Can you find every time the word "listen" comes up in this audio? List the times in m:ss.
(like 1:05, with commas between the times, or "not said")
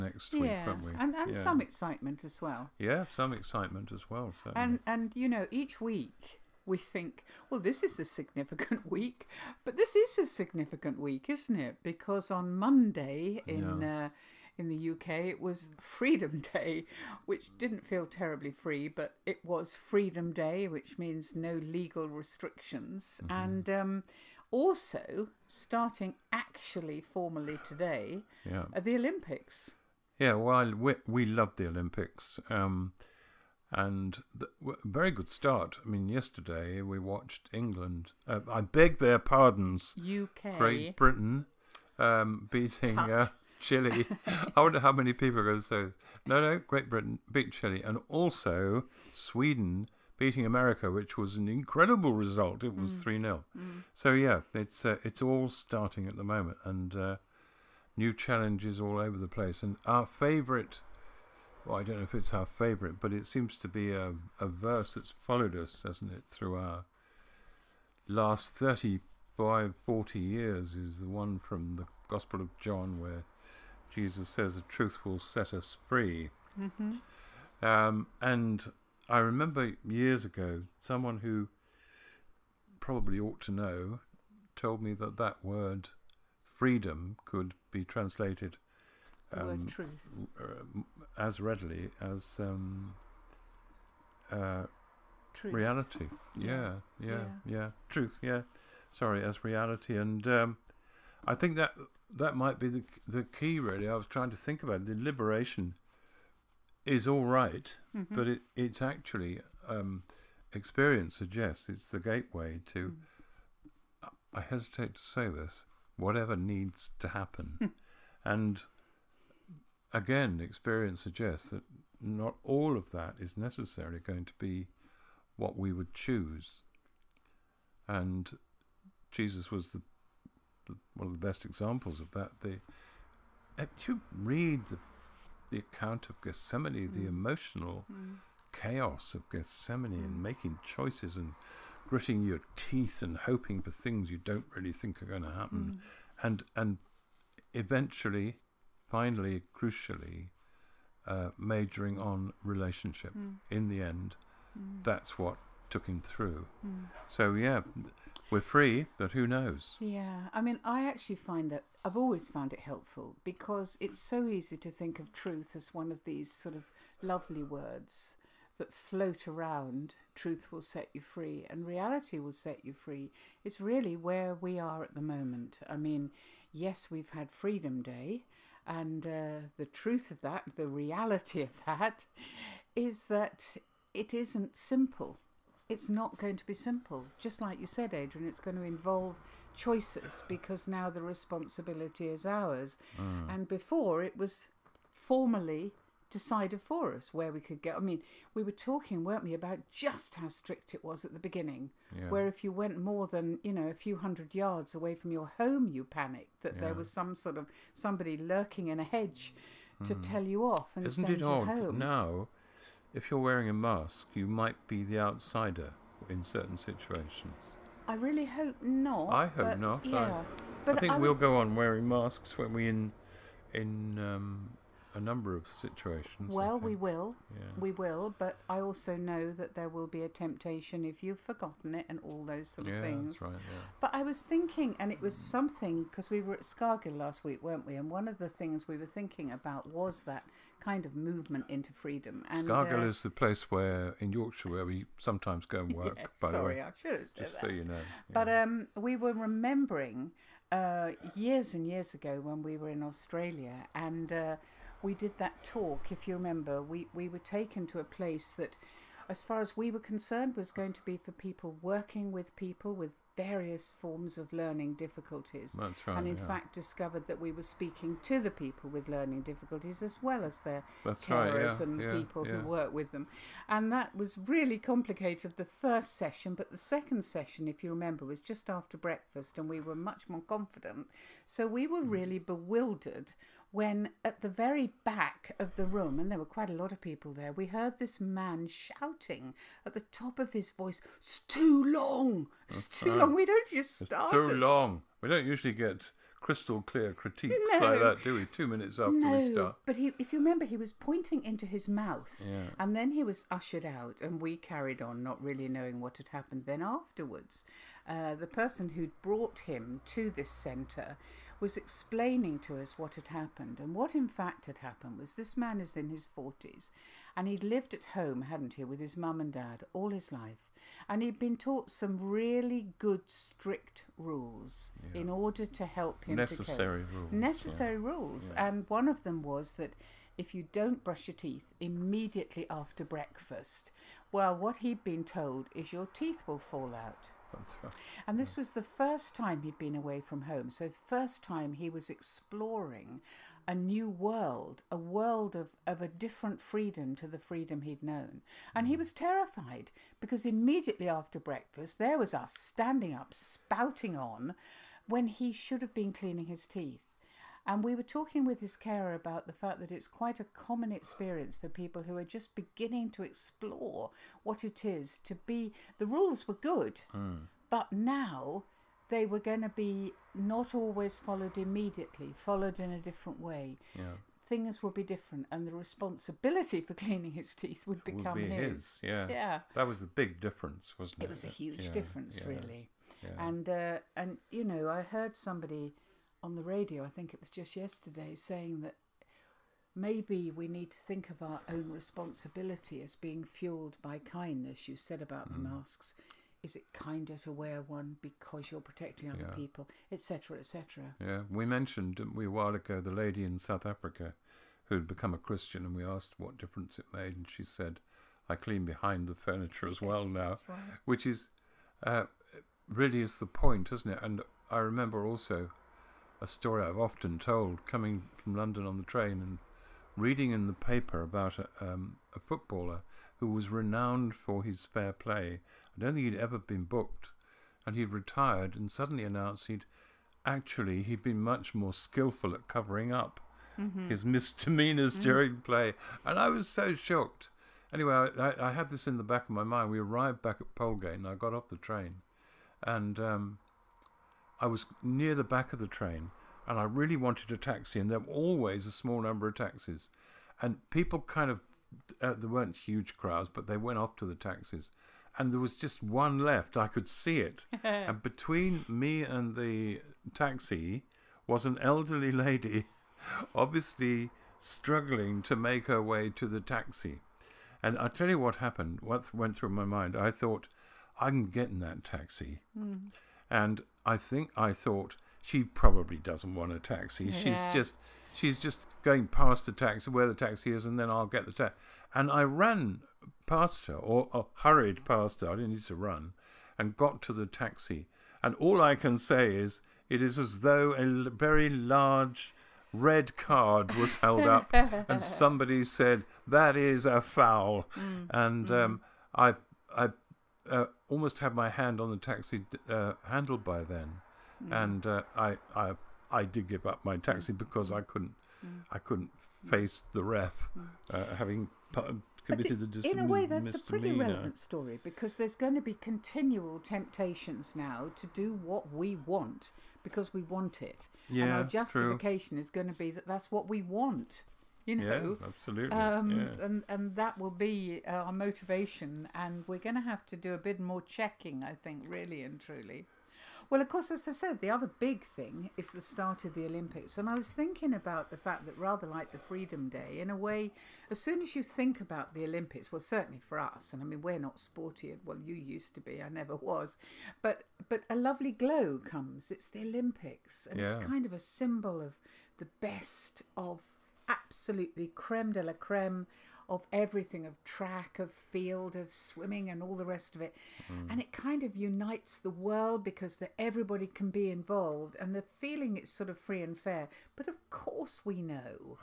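not said.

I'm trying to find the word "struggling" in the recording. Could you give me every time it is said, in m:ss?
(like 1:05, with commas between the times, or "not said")
7:44.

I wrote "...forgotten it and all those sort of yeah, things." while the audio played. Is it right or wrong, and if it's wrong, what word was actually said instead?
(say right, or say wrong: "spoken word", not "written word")
right.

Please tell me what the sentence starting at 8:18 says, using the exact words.
Um, I I uh, almost had my hand on the taxi uh, handle by then, mm.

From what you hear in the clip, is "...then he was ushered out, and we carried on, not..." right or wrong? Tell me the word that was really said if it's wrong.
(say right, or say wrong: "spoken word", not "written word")
right.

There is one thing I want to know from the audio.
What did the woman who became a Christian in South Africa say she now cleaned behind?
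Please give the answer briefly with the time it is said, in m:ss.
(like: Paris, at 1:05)
the furniture, at 6:49.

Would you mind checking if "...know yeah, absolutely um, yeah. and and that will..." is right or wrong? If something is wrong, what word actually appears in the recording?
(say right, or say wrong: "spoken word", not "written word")
right.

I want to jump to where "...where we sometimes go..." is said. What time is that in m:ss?
4:04.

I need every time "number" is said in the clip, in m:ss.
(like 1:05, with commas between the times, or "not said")
3:45, 7:29.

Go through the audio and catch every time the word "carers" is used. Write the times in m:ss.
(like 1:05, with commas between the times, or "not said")
4:31, 5:58.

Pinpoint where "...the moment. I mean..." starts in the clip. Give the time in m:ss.
2:54.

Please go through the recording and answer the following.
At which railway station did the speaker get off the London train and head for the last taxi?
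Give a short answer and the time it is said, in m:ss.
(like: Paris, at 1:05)
Polegate, at 7:20.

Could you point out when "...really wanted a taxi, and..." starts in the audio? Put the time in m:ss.
7:26.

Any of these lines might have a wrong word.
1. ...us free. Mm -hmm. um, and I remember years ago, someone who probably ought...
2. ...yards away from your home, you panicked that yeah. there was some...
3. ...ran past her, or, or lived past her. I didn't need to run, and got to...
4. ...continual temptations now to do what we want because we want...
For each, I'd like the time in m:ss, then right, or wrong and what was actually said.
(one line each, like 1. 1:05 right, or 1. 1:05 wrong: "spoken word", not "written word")
1. 1:15 right
2. 3:24 right
3. 8:02 wrong: "hurried", not "lived"
4. 8:35 right.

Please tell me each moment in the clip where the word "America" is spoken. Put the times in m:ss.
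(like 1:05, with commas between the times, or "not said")
0:50.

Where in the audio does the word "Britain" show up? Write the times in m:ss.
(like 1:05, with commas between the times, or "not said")
0:40, 0:46.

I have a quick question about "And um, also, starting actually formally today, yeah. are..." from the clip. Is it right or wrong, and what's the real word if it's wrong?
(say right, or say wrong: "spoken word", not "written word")
right.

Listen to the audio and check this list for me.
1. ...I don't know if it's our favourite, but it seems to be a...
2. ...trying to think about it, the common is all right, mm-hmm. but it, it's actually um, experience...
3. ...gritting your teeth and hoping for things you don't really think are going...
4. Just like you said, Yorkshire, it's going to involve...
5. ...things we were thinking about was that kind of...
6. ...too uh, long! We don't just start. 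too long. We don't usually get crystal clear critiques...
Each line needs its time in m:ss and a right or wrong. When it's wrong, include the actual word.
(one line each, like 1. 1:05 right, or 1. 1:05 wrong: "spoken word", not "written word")
1. 1:01 right
2. 1:44 wrong: "liberation", not "common"
3. 2:21 right
4. 3:07 wrong: "Adrian", not "Yorkshire"
5. 3:58 right
6. 4:52 right.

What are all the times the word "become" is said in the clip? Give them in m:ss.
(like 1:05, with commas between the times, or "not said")
6:17, 6:44.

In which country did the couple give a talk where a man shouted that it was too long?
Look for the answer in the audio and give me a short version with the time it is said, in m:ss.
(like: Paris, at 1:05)
Australia, at 4:12.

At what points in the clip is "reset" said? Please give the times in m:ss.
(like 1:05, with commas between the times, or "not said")
not said.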